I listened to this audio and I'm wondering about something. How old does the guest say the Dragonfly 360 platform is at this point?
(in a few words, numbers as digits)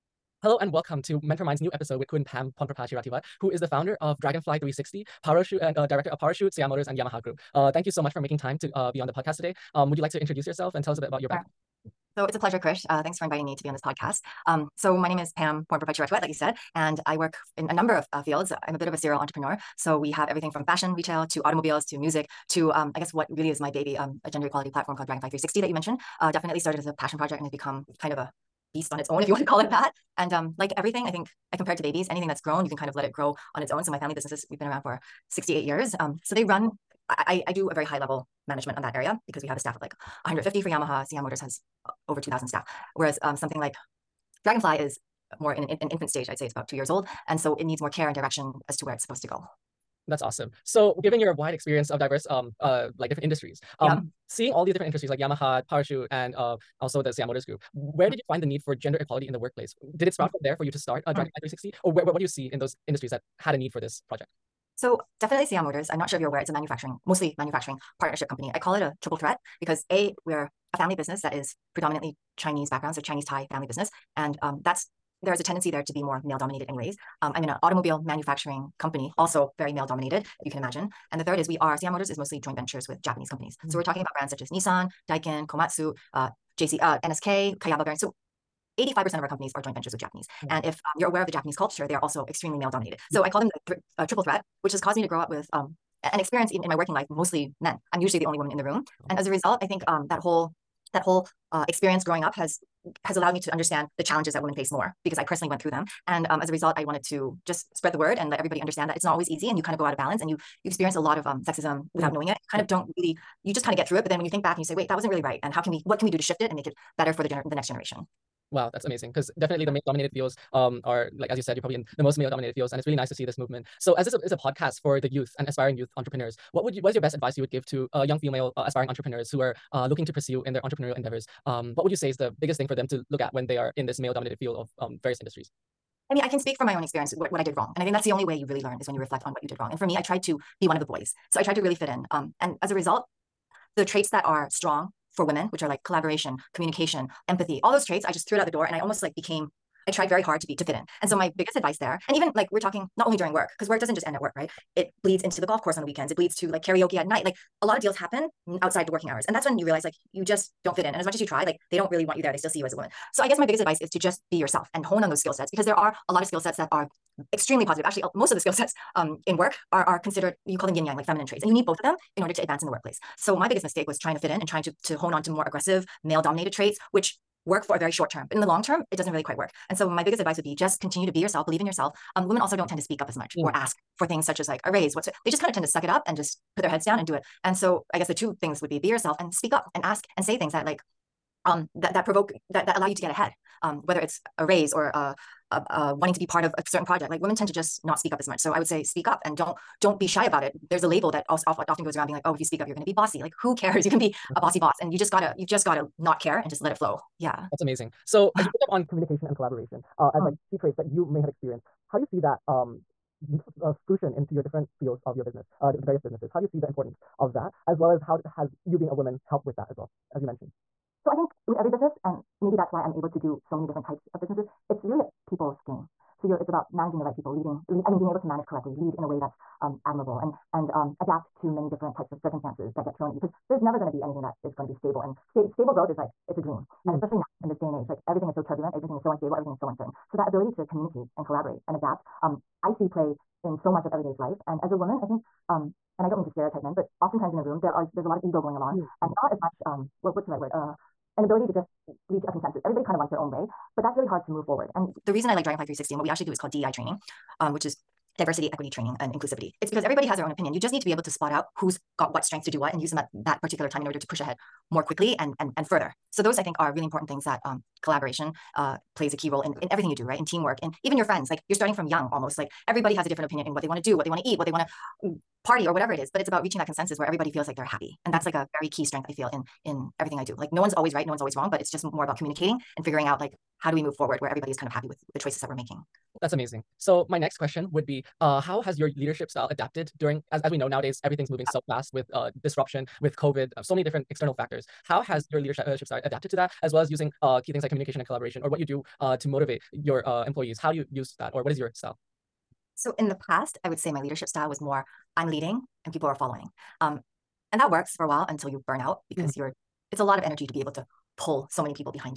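about 2 years.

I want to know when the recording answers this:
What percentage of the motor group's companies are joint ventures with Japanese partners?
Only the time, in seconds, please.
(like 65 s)
88 s.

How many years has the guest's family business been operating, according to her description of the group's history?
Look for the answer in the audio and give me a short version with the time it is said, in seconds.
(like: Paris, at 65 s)
68, at 35 s.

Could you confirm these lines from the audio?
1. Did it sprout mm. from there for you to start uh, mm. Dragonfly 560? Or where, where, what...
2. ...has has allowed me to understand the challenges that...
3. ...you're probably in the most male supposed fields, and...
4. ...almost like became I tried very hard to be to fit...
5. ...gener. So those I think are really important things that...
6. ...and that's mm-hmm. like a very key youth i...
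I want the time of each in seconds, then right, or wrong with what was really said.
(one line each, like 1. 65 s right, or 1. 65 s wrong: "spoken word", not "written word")
1. 59 s wrong: "360", not "560"
2. 102 s right
3. 121 s wrong: "dominated", not "supposed"
4. 148 s right
5. 265 s wrong: "further", not "gener"
6. 278 s wrong: "strength", not "youth".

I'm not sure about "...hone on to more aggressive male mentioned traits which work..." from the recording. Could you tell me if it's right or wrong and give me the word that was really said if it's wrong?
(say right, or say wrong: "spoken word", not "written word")
wrong: "dominated", not "mentioned".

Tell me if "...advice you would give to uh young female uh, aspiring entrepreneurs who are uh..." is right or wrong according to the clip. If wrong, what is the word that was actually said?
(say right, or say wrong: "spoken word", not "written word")
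right.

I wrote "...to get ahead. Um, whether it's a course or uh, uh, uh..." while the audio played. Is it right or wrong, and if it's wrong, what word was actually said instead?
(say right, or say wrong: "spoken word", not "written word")
wrong: "raise", not "course".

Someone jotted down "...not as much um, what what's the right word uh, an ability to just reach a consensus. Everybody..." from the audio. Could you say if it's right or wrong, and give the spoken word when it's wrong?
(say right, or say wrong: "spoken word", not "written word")
right.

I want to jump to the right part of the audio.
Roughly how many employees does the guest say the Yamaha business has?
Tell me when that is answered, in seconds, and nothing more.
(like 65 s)
40 s.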